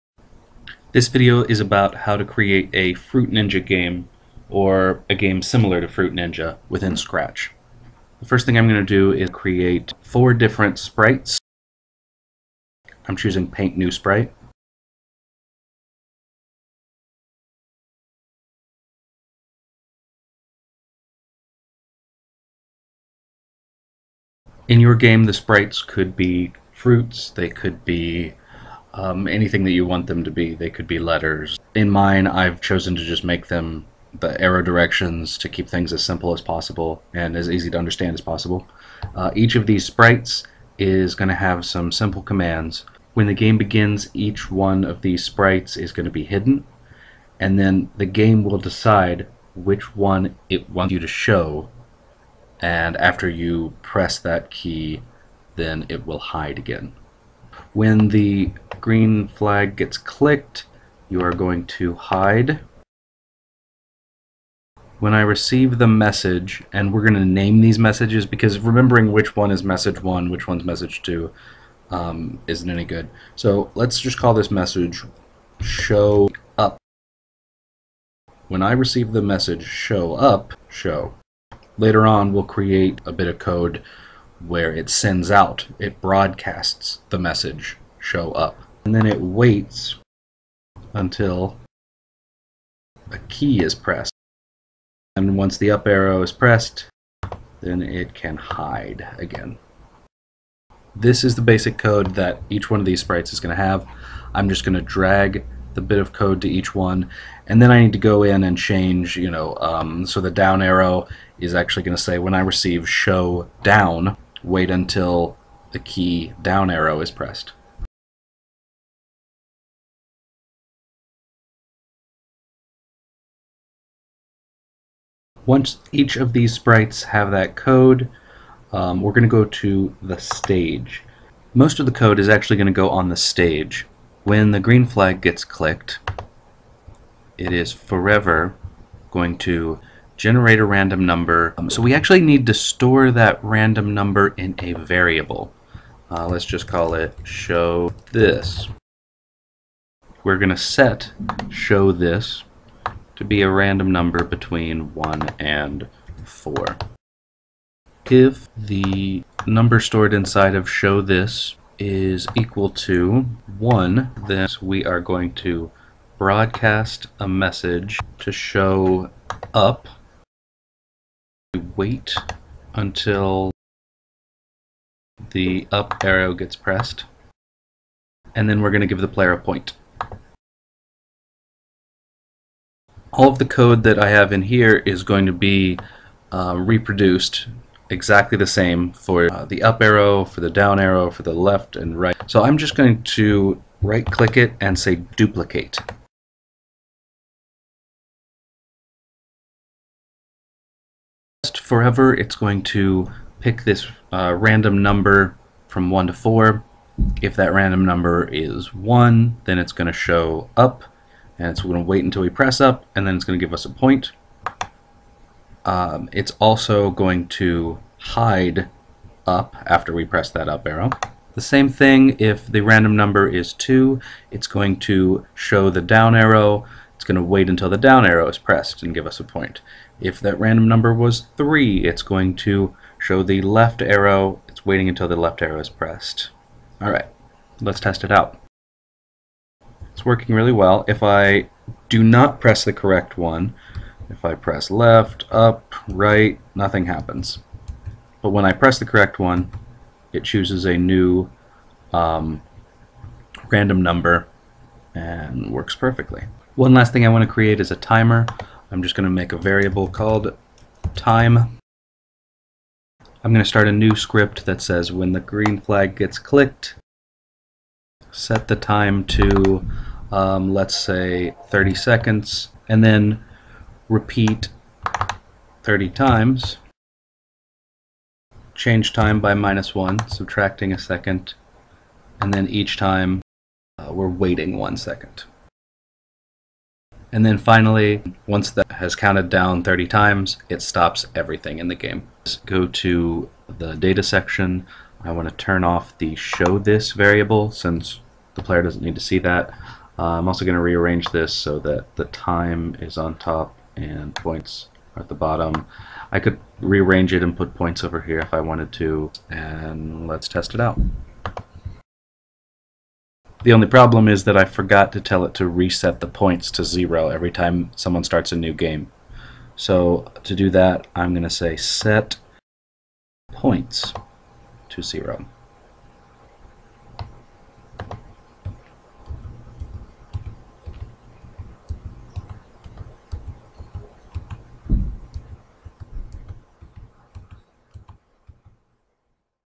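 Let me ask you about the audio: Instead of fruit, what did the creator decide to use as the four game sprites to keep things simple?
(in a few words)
arrow directions.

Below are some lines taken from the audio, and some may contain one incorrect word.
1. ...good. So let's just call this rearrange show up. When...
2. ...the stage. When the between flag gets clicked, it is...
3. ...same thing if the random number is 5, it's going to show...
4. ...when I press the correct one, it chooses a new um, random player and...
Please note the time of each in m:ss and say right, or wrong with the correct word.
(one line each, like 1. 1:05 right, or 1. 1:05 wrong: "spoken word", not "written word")
1. 1:12 wrong: "message", not "rearrange"
2. 2:13 wrong: "green", not "between"
3. 3:41 wrong: "2", not "5"
4. 4:08 wrong: "number", not "player".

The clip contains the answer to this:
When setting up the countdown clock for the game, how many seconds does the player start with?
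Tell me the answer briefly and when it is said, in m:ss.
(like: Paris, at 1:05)
30, at 4:31.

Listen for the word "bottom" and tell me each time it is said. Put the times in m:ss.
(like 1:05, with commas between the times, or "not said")
5:05.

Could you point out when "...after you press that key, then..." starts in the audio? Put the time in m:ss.
0:52.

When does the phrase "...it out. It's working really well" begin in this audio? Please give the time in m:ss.
3:58.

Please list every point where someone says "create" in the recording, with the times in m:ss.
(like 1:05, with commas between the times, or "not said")
0:02, 0:09, 1:22, 4:17.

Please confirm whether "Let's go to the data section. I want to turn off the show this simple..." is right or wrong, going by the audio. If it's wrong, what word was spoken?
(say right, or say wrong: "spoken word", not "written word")
wrong: "variable", not "simple".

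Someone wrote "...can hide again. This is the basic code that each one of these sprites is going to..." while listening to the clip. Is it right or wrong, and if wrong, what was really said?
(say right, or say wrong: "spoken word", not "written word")
right.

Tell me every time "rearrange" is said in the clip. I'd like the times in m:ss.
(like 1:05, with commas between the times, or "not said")
5:00, 5:06.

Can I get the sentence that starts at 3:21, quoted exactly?
Forever it's going to pick this uh, random number from 1 to 4.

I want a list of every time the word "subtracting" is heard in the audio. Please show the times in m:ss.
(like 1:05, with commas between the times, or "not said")
4:40.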